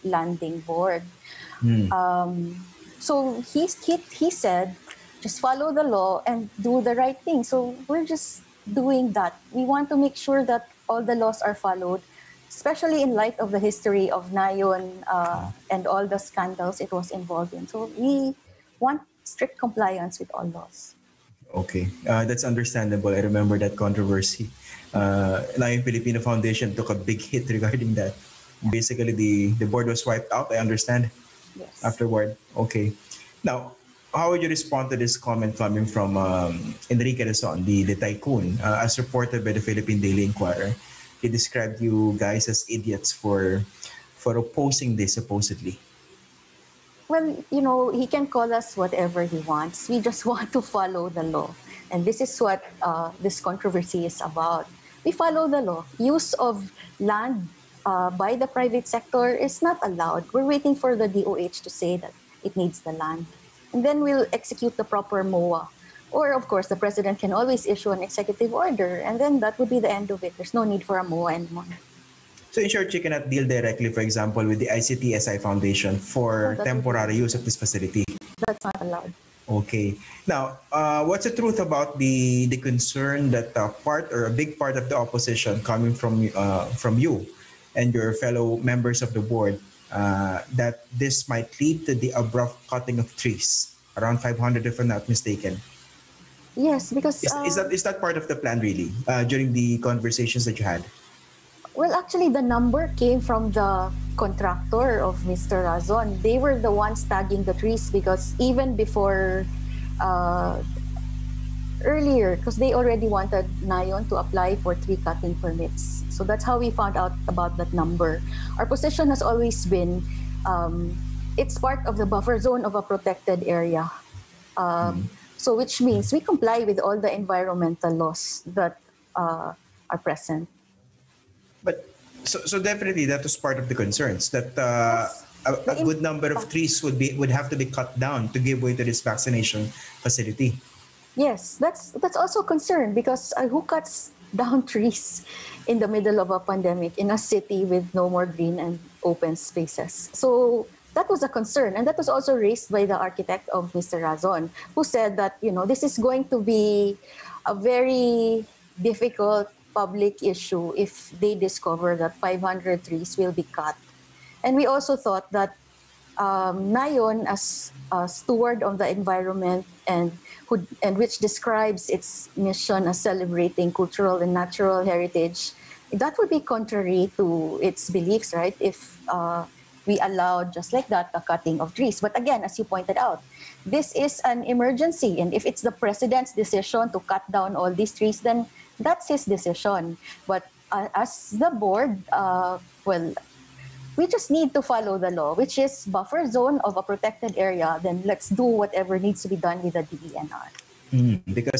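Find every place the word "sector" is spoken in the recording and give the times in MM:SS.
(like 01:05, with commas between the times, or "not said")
00:58.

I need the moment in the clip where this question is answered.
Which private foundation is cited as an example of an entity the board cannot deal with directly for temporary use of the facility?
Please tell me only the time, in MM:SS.
01:14.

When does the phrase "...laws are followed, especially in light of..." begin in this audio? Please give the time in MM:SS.
00:11.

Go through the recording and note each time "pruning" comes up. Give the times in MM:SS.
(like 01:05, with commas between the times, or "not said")
not said.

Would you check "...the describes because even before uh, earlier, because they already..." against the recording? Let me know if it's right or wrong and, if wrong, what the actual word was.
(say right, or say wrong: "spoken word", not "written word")
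wrong: "trees", not "describes".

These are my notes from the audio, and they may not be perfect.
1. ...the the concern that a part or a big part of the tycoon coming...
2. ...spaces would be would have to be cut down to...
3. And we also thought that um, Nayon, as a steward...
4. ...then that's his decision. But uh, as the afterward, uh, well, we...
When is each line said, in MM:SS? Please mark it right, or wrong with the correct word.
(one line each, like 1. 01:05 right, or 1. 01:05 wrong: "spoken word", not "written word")
1. 01:21 wrong: "opposition", not "tycoon"
2. 02:16 wrong: "trees", not "spaces"
3. 02:44 right
4. 03:08 wrong: "board", not "afterward".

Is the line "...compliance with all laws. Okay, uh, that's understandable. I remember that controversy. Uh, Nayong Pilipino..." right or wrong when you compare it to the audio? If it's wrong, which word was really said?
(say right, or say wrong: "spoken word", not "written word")
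right.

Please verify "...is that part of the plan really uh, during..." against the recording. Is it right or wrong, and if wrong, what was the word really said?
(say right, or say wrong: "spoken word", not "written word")
right.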